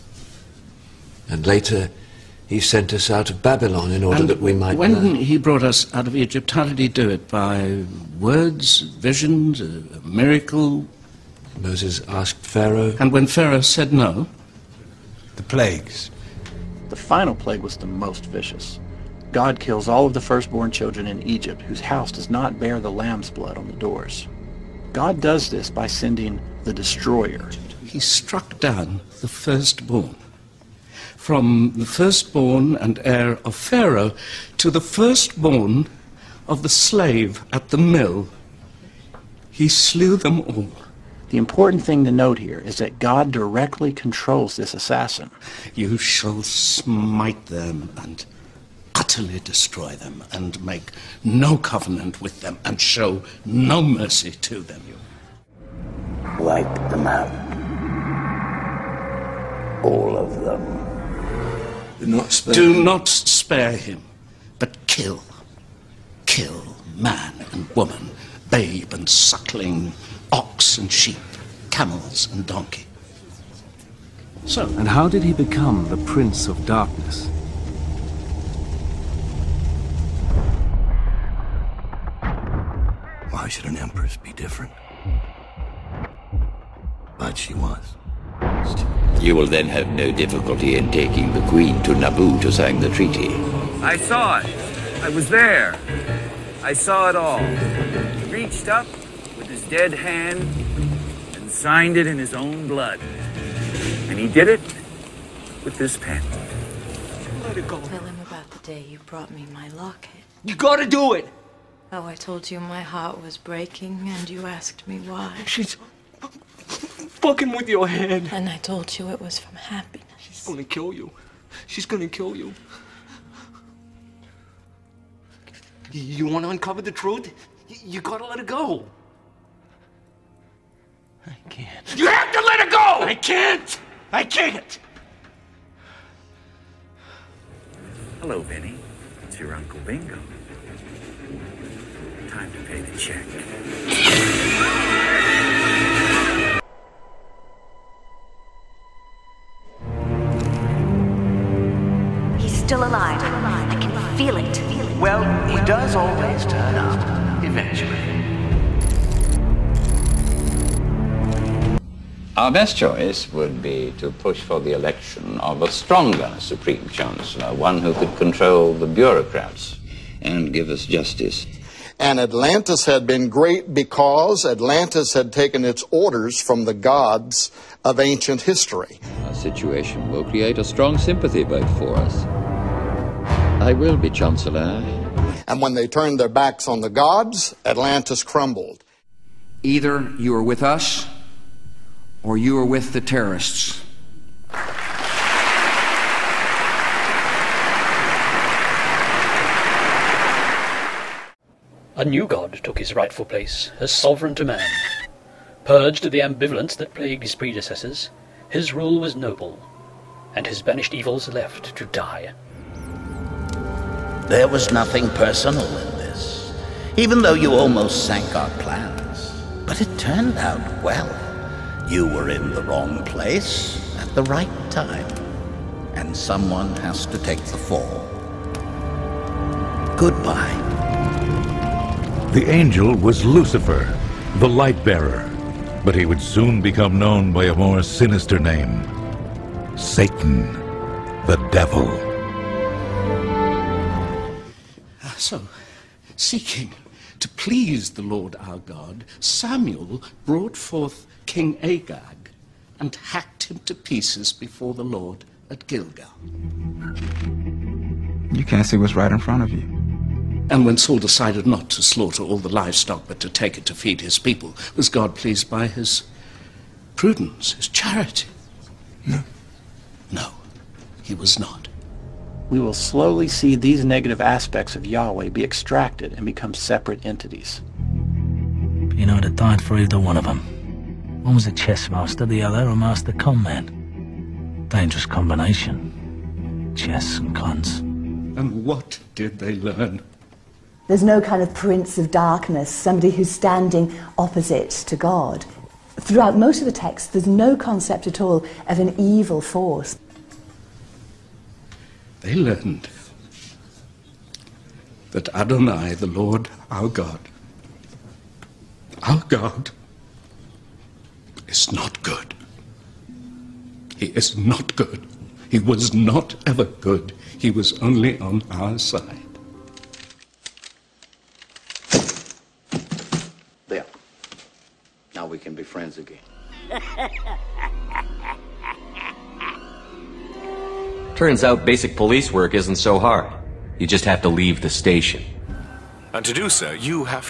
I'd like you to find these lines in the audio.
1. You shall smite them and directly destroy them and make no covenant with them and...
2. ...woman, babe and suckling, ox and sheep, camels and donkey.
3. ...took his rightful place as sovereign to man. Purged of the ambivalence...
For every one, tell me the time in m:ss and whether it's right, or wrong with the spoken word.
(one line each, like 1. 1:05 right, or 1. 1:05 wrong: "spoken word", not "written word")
1. 0:45 wrong: "utterly", not "directly"
2. 1:07 right
3. 3:22 right.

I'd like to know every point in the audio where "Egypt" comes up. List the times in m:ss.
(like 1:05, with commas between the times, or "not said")
0:06, 0:21.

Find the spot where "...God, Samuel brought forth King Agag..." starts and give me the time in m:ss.
4:08.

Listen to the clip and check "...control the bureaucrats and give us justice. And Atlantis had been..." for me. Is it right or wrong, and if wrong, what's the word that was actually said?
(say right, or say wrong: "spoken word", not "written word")
right.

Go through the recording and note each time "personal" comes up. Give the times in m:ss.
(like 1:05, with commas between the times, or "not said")
3:35.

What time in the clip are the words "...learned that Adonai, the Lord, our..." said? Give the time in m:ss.
5:02.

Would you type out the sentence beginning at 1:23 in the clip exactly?
Why should an empress be different?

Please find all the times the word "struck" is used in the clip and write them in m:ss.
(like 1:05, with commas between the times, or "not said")
0:27.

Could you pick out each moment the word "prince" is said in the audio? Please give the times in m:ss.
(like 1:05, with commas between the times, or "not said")
1:15, 4:51.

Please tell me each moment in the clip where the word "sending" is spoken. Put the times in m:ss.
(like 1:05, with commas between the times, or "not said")
0:25.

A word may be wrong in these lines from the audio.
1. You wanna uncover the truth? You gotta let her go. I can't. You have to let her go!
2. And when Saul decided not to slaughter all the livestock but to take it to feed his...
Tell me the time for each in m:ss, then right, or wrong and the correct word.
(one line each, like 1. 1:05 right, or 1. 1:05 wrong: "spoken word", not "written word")
1. 2:05 right
2. 4:20 right.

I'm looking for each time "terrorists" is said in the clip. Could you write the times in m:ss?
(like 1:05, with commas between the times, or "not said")
3:12.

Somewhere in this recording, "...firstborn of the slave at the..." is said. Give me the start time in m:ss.
0:34.